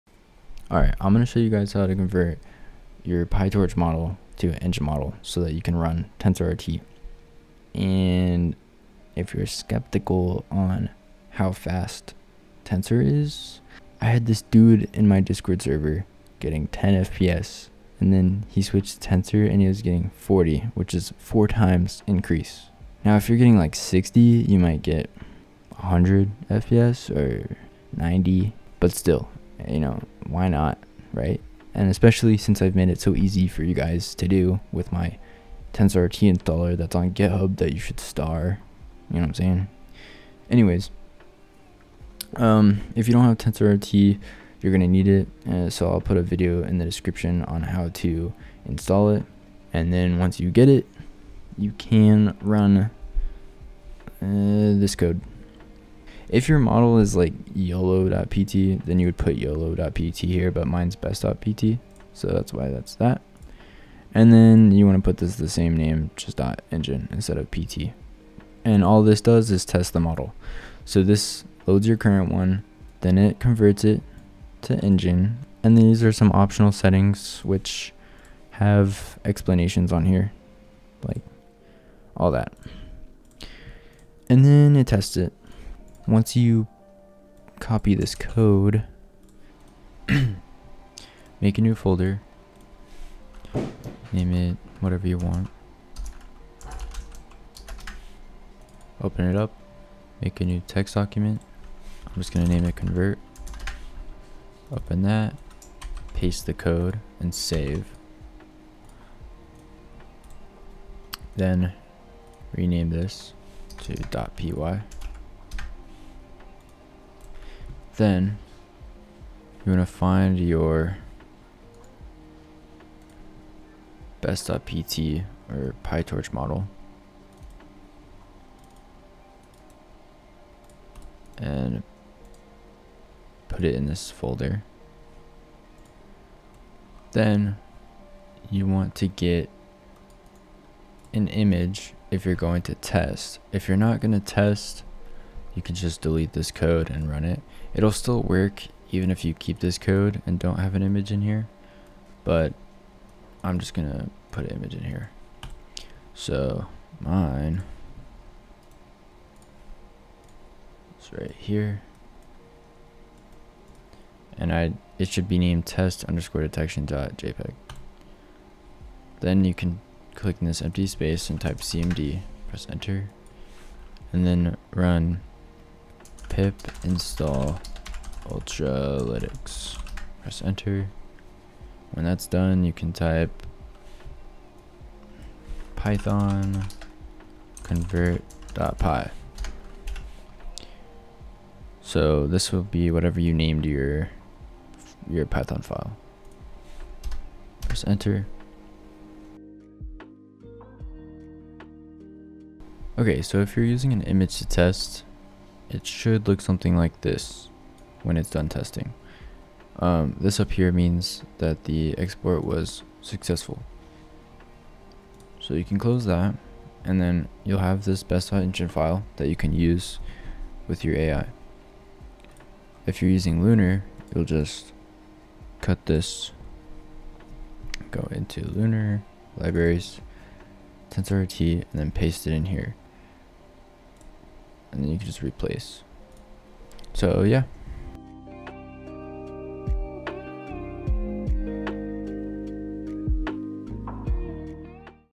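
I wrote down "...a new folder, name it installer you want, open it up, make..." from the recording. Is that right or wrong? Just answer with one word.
wrong.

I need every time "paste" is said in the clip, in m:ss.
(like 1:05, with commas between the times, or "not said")
1:46, 3:51.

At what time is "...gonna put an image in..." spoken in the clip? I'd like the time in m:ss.
2:33.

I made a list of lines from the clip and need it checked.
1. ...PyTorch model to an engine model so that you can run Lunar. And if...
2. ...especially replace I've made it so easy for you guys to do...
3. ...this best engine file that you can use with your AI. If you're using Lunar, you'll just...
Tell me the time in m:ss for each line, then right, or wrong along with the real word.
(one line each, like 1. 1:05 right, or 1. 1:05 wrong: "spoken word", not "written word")
1. 0:03 wrong: "TensorRT", not "Lunar"
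2. 0:31 wrong: "since", not "replace"
3. 3:37 right.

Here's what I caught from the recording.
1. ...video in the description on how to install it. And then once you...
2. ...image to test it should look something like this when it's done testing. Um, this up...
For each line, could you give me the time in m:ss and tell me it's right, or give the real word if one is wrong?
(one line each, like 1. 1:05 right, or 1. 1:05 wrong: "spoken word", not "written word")
1. 0:46 right
2. 3:24 right.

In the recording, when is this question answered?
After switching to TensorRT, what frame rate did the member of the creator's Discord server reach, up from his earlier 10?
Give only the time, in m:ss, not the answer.
0:20.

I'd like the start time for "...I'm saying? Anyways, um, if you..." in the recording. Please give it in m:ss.
0:39.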